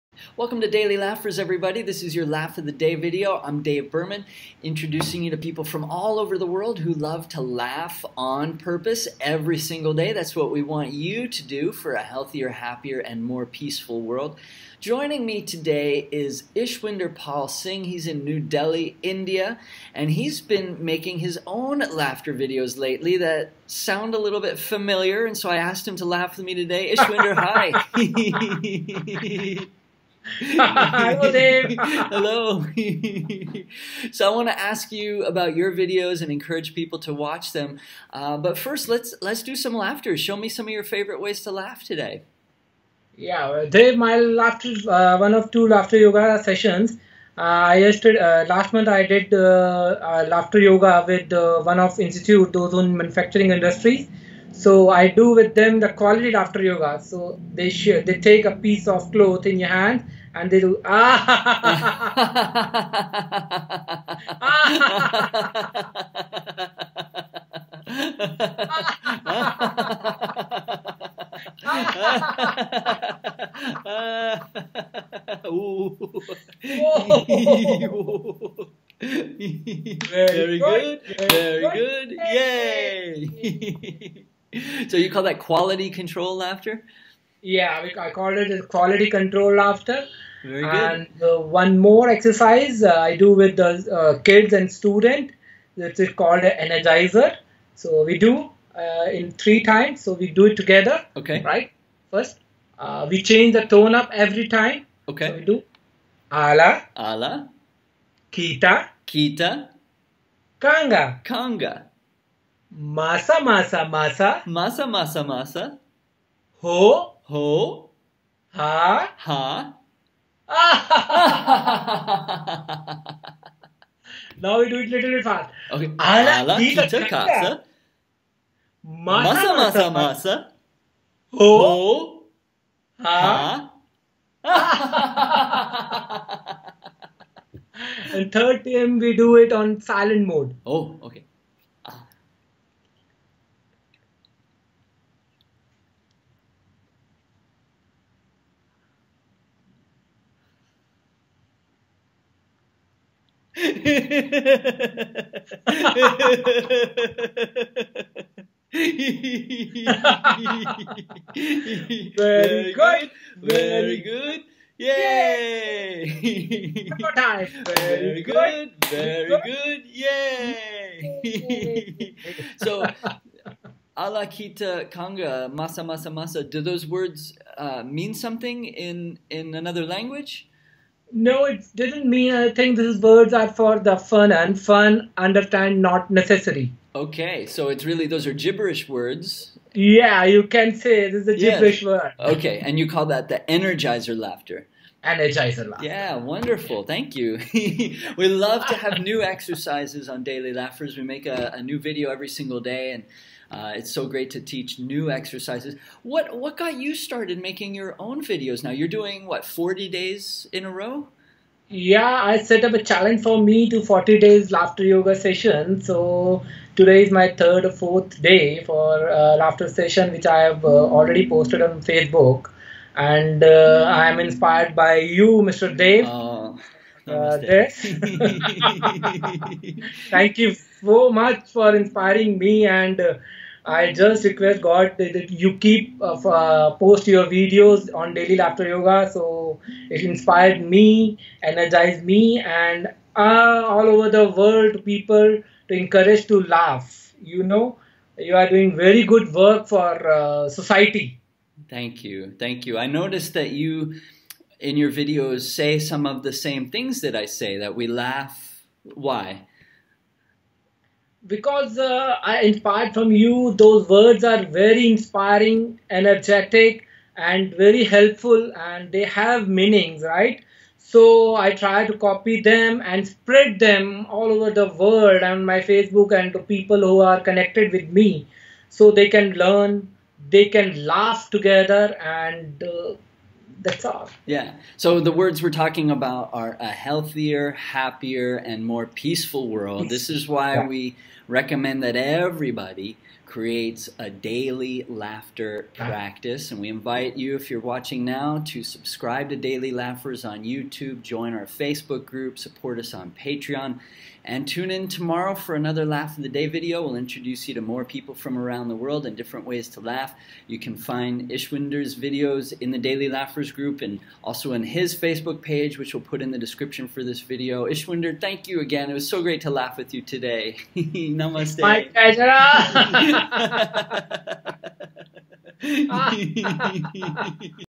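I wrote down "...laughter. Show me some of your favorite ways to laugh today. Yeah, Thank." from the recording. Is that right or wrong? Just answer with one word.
wrong.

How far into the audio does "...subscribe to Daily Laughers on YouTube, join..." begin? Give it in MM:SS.
04:58.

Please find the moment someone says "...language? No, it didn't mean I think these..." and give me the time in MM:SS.
02:59.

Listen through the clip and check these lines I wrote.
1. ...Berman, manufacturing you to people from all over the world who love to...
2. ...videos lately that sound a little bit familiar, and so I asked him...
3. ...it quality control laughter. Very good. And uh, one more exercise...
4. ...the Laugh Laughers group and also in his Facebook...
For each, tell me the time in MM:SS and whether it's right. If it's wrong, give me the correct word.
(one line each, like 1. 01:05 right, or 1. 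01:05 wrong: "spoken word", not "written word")
1. 00:03 wrong: "introducing", not "manufacturing"
2. 00:22 right
3. 01:28 right
4. 05:12 wrong: "Daily", not "Laugh".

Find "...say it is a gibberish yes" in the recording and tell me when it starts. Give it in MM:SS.
03:10.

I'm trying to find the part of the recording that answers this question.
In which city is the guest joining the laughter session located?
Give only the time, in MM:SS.
00:18.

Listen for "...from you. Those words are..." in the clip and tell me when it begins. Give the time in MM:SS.
04:22.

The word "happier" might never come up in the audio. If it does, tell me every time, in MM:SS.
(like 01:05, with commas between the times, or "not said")
00:12, 04:47.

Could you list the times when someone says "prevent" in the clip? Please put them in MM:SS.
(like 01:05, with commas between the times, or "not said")
not said.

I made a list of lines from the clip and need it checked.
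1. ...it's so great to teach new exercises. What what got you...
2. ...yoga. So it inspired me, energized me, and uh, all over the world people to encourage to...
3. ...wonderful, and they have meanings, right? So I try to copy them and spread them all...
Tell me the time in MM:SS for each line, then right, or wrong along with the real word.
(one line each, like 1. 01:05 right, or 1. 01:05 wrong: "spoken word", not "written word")
1. 03:23 right
2. 03:58 right
3. 04:27 wrong: "helpful", not "wonderful".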